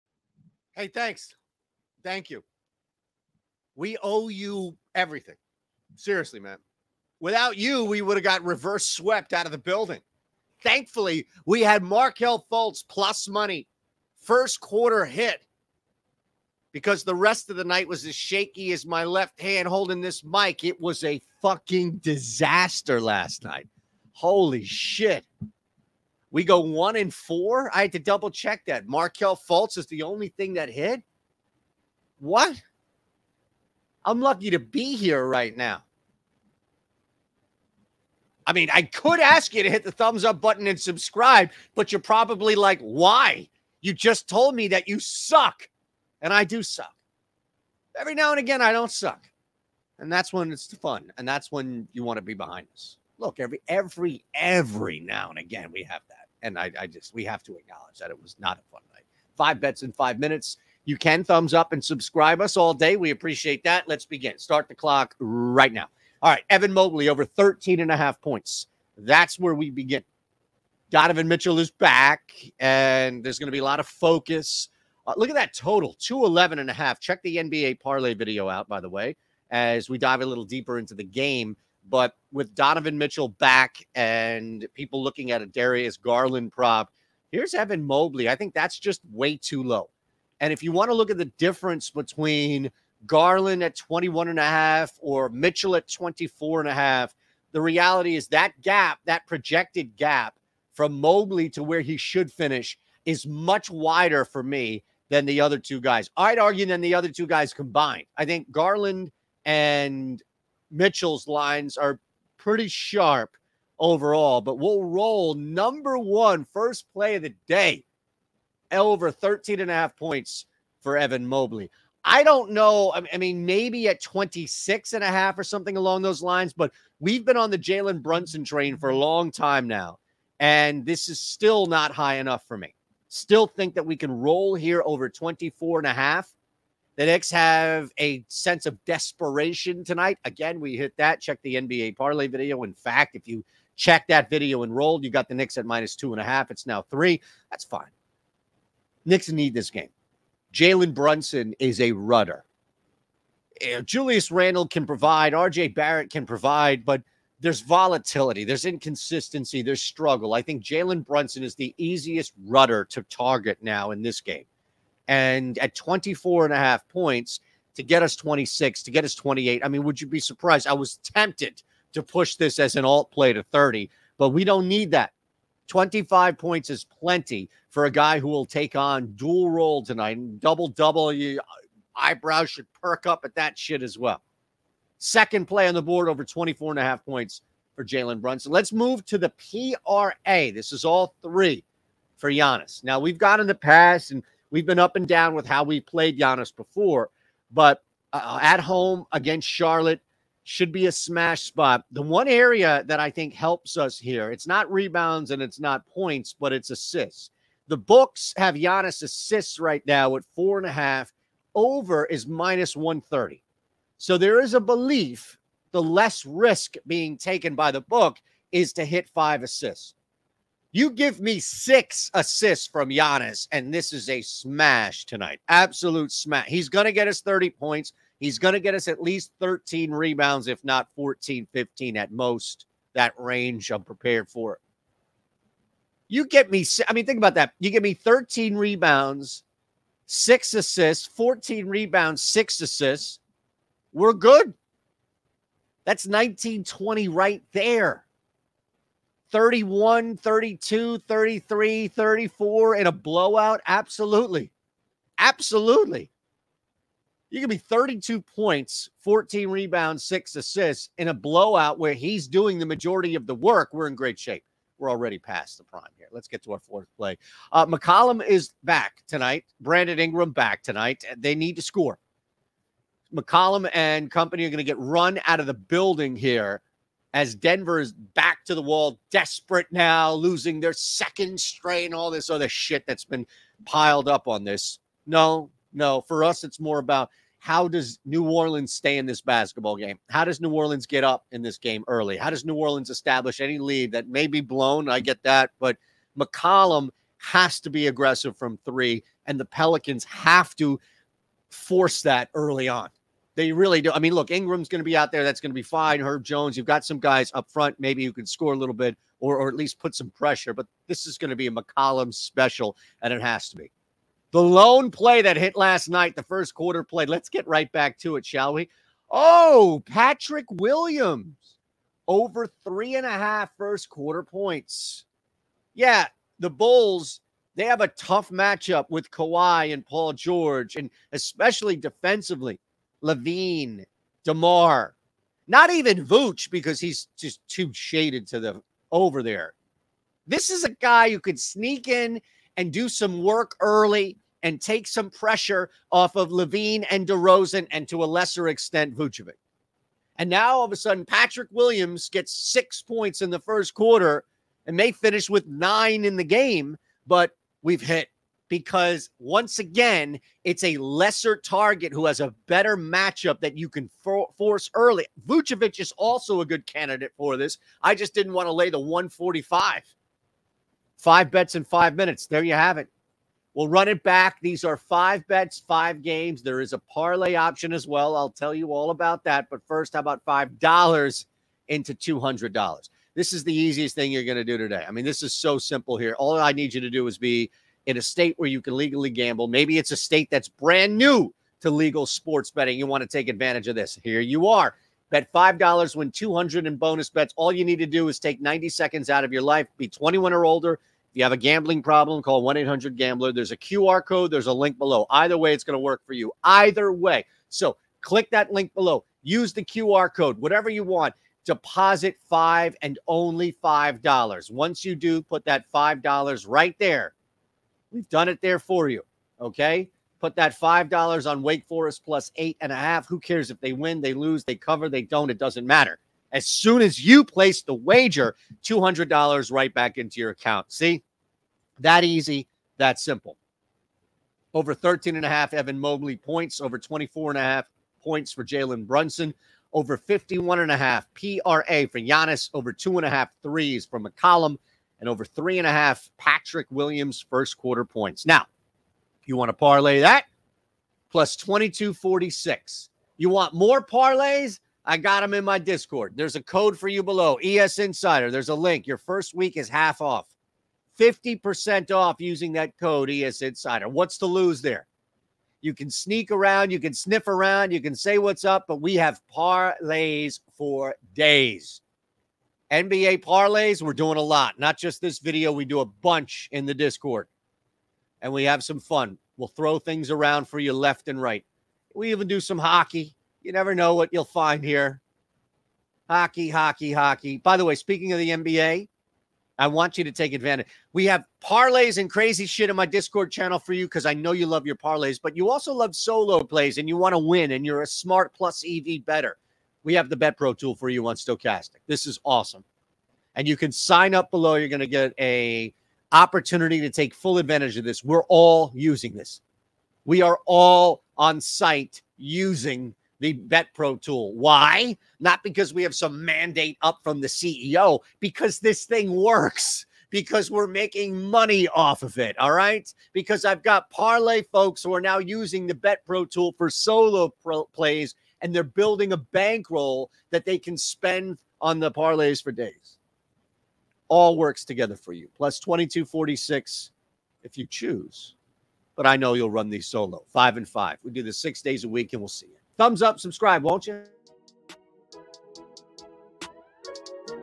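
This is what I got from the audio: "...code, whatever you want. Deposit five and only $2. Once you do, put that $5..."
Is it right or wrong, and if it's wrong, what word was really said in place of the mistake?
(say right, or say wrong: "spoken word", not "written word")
wrong: "5", not "2".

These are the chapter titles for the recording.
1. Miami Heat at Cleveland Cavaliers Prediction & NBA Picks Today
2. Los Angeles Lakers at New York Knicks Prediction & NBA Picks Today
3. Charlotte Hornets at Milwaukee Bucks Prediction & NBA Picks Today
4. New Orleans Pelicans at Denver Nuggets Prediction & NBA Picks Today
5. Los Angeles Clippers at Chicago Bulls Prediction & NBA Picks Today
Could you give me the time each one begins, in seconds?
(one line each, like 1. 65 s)
1. 45 s
2. 105 s
3. 165 s
4. 225 s
5. 285 s.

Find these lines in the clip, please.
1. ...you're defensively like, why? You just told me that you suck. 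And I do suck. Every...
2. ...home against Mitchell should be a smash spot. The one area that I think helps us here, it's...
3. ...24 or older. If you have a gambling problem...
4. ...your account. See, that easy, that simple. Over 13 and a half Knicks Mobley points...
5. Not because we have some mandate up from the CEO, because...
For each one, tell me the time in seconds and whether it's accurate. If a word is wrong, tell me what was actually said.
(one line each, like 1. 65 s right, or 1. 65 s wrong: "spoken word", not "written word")
1. 41 s wrong: "probably", not "defensively"
2. 198 s wrong: "Charlotte", not "Mitchell"
3. 399 s wrong: "21", not "24"
4. 430 s wrong: "Evan", not "Knicks"
5. 515 s right.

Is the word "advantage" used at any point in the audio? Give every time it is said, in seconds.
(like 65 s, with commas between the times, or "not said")
393 s, 490 s, 507 s.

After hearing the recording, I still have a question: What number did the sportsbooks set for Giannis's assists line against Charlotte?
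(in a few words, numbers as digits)
4.5.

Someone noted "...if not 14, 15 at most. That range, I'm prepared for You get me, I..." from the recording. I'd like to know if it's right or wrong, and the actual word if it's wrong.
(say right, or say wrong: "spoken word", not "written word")
right.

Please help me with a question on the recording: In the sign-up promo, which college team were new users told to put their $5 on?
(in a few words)
Wake Forest.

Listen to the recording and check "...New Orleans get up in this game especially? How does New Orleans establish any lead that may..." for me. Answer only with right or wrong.
wrong.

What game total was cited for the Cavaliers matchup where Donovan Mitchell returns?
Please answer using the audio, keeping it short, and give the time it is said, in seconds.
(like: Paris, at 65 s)
211.5, at 75 s.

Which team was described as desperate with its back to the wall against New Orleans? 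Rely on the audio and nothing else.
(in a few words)
Denver.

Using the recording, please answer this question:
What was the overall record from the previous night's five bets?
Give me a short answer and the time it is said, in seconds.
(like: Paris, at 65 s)
1 and 4, at 26 s.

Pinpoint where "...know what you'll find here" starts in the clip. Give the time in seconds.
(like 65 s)
483 s.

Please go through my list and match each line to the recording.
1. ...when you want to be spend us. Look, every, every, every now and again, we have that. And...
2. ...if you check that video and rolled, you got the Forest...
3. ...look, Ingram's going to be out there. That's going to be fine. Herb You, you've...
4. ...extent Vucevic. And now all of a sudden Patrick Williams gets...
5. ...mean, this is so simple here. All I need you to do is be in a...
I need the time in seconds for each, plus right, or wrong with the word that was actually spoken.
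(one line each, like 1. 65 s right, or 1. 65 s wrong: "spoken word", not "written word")
1. 51 s wrong: "behind", not "spend"
2. 143 s wrong: "Knicks", not "Forest"
3. 304 s wrong: "Jones", not "You"
4. 348 s right
5. 384 s right.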